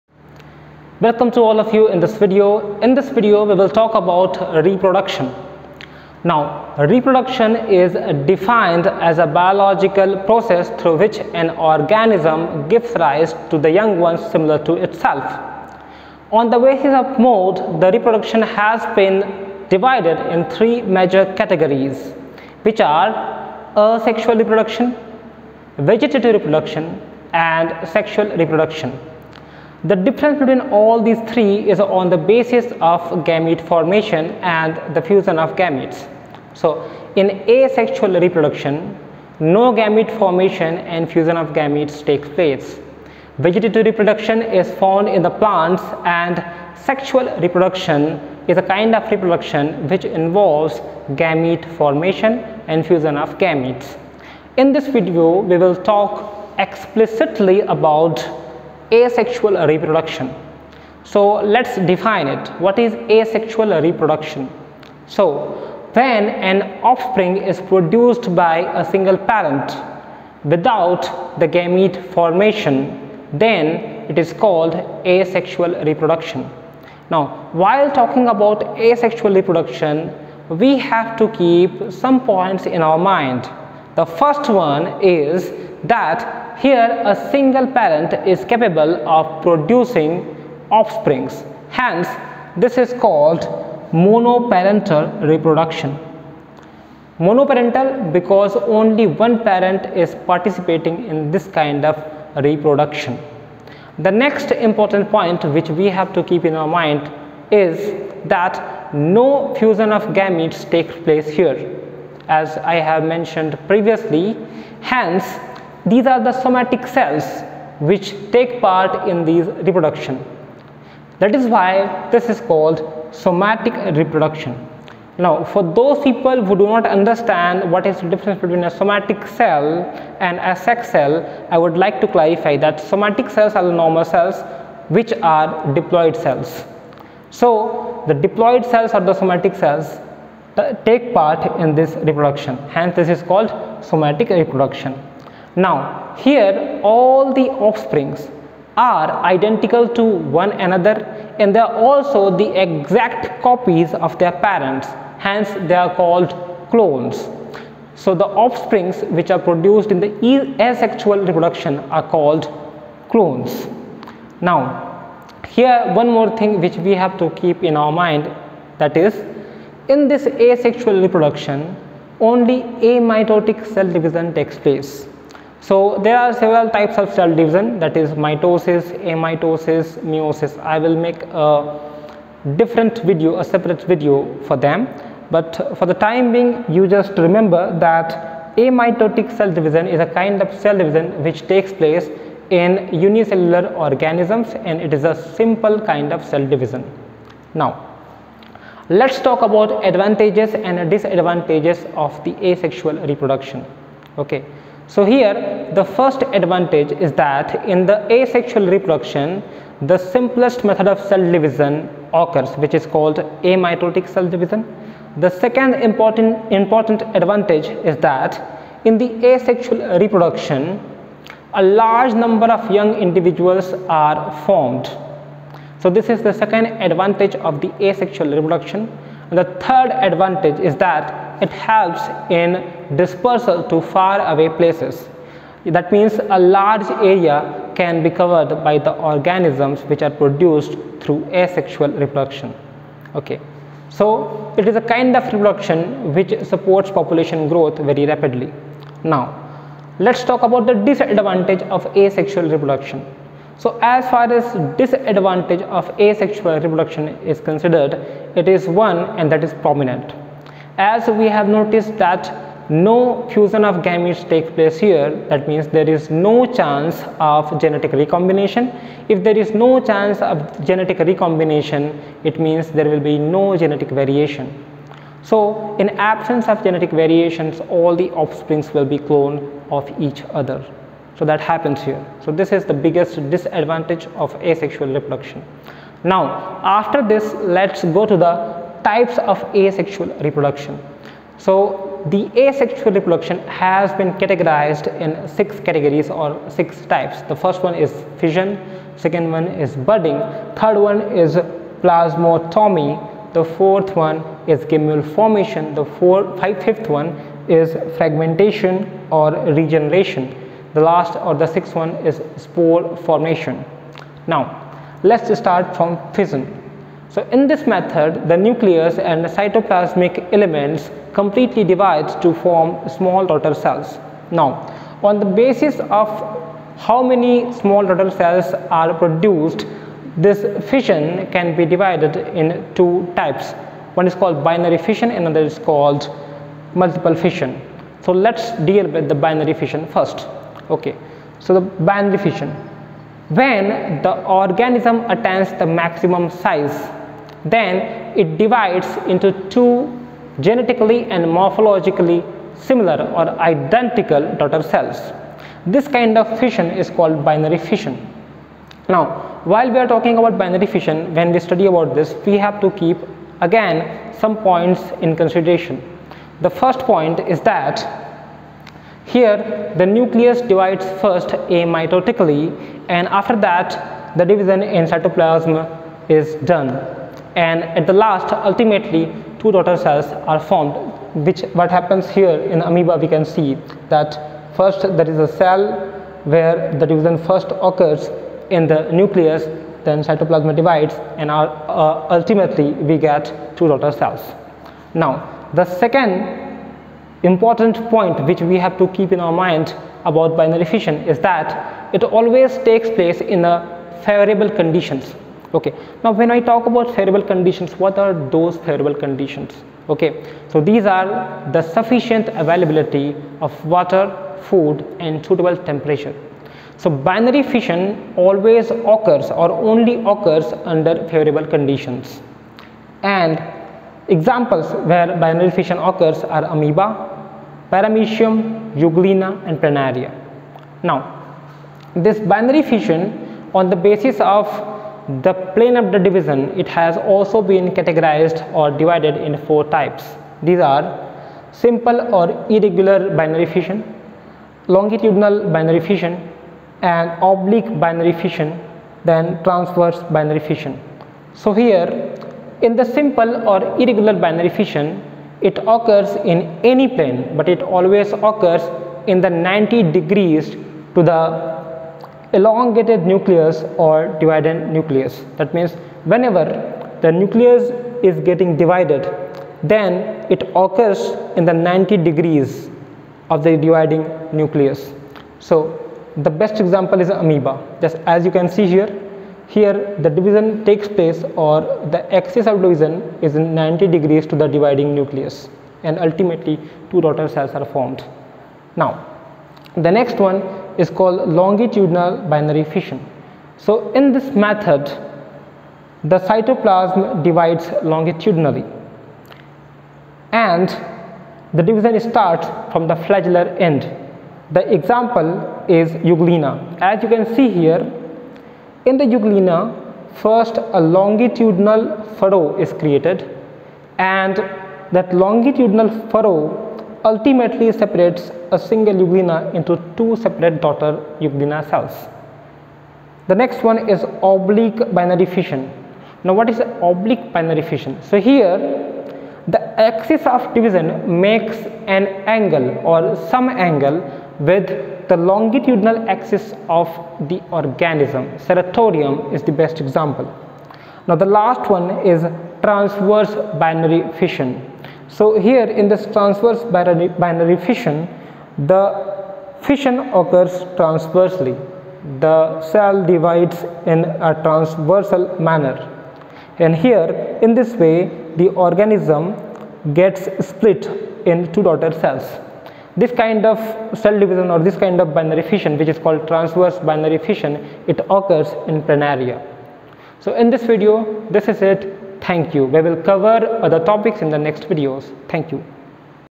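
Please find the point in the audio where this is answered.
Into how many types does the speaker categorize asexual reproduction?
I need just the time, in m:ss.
4:56.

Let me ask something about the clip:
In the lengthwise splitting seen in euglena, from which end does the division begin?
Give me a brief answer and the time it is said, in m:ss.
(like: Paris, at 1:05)
flagellar end, at 8:22.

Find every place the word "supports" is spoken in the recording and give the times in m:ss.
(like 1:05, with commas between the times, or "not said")
4:06.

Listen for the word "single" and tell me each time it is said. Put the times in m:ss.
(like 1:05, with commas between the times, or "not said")
1:08, 1:27, 8:38.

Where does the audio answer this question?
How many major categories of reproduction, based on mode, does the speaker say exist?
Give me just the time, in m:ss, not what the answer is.
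0:20.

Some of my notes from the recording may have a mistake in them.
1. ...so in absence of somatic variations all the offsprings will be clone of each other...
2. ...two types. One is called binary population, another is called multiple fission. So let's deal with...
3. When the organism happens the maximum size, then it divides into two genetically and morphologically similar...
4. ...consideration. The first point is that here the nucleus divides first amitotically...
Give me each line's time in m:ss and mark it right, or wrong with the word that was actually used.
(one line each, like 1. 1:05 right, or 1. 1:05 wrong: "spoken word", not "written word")
1. 4:35 wrong: "genetic", not "somatic"
2. 5:32 wrong: "fission", not "population"
3. 5:43 wrong: "attains", not "happens"
4. 6:05 right.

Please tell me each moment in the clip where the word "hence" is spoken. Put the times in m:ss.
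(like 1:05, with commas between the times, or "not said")
1:31, 1:54, 2:22, 2:35.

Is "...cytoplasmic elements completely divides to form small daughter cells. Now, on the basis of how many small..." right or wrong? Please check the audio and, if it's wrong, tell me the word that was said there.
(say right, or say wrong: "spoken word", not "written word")
right.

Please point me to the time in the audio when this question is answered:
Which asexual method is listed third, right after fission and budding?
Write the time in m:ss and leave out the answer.
5:01.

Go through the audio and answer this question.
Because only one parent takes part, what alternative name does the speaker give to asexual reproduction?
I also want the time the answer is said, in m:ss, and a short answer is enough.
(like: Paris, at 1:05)
monoparental reproduction, at 1:33.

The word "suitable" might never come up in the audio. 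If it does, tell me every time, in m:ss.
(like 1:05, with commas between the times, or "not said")
6:55.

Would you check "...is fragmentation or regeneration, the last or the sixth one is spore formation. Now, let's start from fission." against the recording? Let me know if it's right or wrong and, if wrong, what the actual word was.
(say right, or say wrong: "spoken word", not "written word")
right.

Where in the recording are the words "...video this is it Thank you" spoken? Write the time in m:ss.
9:30.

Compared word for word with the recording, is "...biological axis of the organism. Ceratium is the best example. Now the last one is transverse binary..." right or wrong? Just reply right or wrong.
wrong.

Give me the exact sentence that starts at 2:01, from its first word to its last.
That is why this is called somatic reproduction.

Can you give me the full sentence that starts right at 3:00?
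I will make a different video, a separate video for them.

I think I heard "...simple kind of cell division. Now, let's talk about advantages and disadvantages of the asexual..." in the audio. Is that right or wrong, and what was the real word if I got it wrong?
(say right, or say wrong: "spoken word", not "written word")
right.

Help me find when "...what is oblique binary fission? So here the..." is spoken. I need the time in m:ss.
8:46.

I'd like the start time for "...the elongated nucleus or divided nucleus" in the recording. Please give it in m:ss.
7:41.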